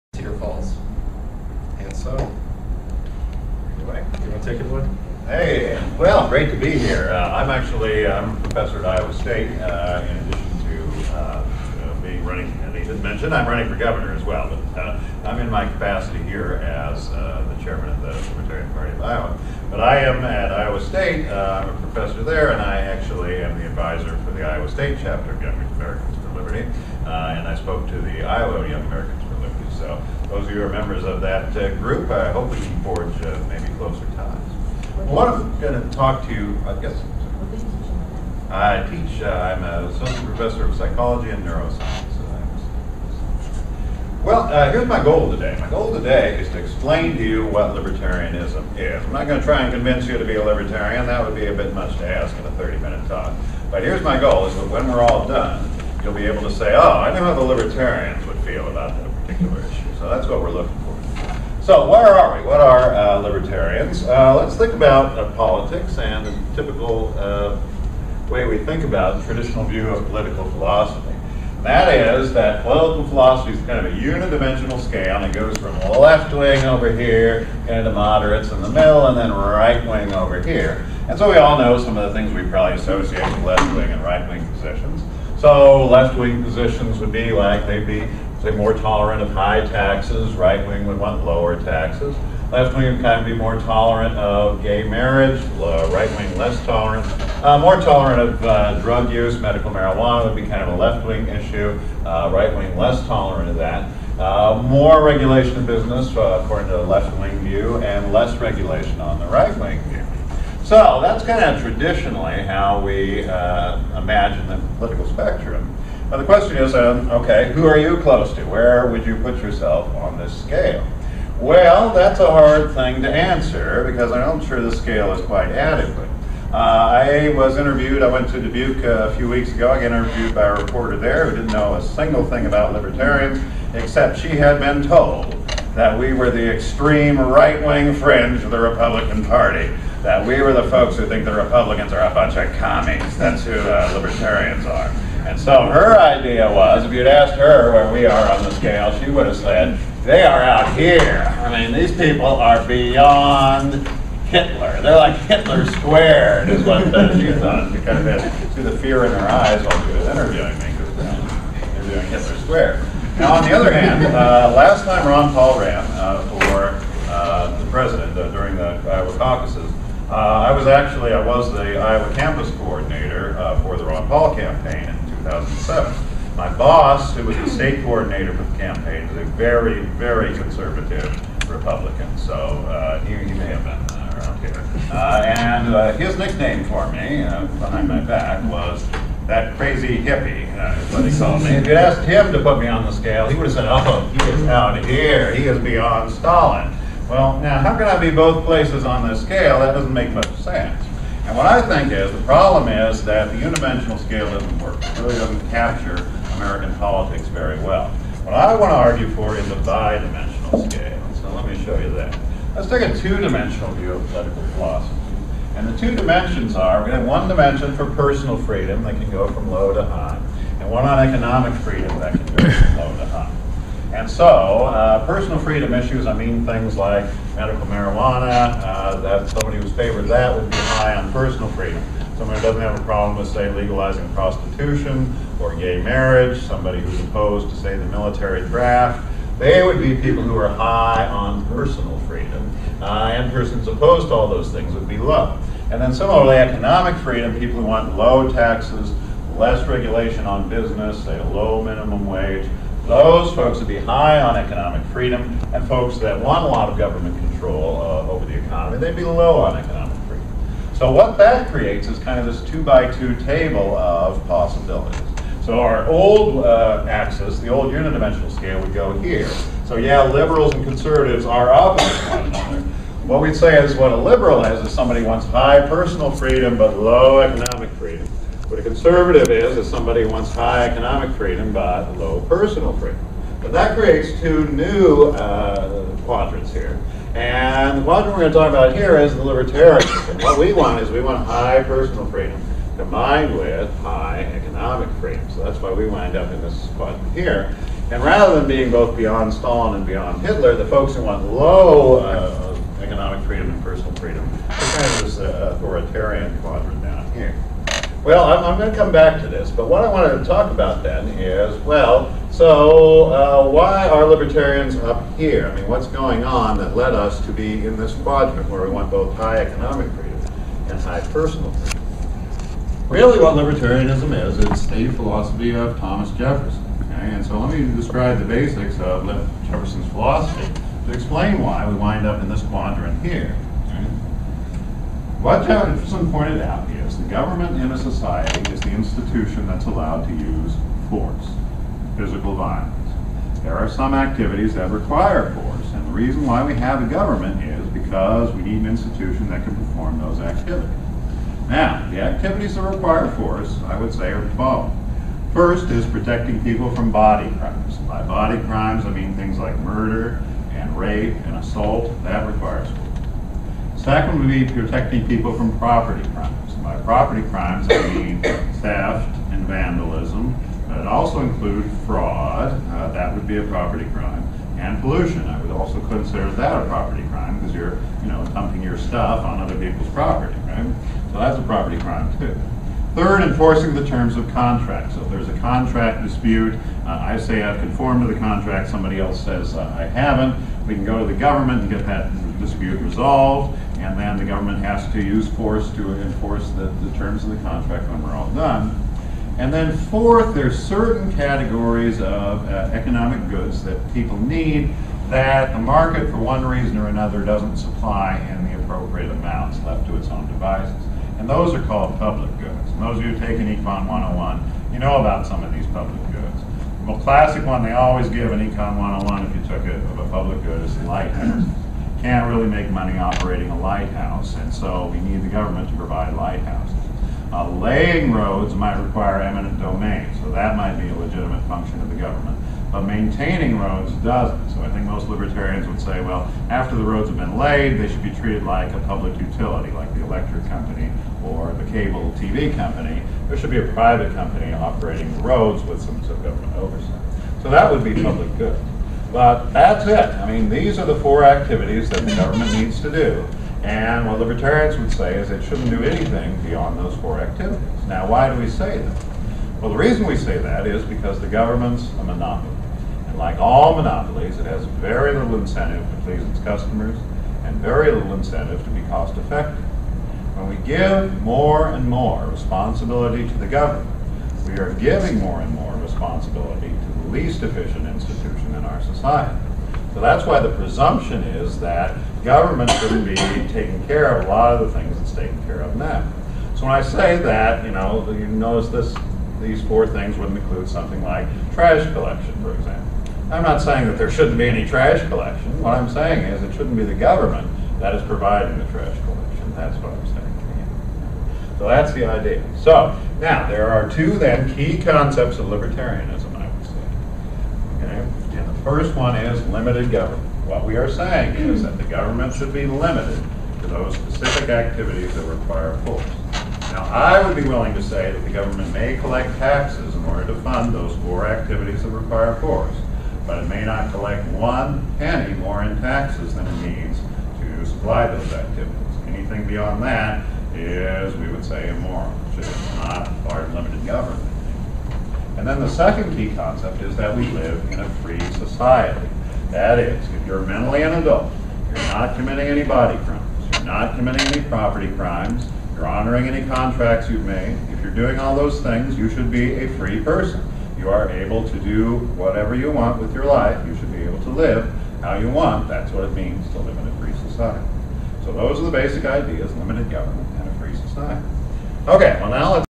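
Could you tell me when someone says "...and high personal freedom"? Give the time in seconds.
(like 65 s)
320 s.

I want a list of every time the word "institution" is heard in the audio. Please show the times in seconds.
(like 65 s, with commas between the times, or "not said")
338 s, 348 s, 477 s.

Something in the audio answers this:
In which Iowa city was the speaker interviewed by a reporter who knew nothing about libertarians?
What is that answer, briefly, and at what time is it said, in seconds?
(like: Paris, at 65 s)
Dubuque, at 128 s.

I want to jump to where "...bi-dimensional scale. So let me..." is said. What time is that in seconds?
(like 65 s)
209 s.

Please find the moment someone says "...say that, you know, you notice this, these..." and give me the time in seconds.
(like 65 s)
486 s.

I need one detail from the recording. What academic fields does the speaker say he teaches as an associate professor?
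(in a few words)
Psychology and neuroscience.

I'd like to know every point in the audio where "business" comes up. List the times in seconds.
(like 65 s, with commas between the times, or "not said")
105 s, 250 s.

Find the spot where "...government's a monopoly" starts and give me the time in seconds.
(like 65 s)
461 s.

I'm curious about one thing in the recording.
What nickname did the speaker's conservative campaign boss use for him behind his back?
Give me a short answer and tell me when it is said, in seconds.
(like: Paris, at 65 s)
That crazy hippie, at 189 s.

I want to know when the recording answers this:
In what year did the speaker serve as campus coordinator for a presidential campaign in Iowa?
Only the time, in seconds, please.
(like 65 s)
175 s.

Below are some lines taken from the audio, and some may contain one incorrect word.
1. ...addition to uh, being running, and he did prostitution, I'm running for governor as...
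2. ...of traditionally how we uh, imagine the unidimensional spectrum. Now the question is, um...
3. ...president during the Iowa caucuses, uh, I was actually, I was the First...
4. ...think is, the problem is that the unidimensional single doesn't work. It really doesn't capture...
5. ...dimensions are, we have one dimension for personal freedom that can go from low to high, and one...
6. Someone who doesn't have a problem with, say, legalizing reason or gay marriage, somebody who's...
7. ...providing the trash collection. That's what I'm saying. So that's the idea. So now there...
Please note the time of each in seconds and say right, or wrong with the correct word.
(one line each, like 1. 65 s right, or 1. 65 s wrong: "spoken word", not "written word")
1. 10 s wrong: "mention", not "prostitution"
2. 111 s wrong: "political", not "unidimensional"
3. 167 s wrong: "Iowa", not "First"
4. 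201 s wrong: "scale", not "single"
5. 215 s right
6. 232 s wrong: "prostitution", not "reason"
7. 498 s right.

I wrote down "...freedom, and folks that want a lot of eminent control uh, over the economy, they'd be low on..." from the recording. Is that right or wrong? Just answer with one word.
wrong.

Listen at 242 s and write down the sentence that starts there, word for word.
Uh, and persons opposed to all those things would be low.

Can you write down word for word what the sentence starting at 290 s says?
and what we want is we want high personal freedom combined with high economic freedom.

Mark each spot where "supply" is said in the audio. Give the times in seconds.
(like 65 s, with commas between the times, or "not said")
407 s, 527 s.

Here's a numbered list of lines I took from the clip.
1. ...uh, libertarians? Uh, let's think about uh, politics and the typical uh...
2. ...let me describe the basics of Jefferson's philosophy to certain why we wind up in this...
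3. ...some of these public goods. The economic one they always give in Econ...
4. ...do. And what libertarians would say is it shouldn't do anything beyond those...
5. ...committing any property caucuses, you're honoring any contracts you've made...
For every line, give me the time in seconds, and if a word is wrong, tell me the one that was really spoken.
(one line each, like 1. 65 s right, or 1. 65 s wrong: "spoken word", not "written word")
1. 62 s right
2. 327 s wrong: "explain", not "certain"
3. 415 s wrong: "classic", not "economic"
4. 452 s right
5. 543 s wrong: "crimes", not "caucuses".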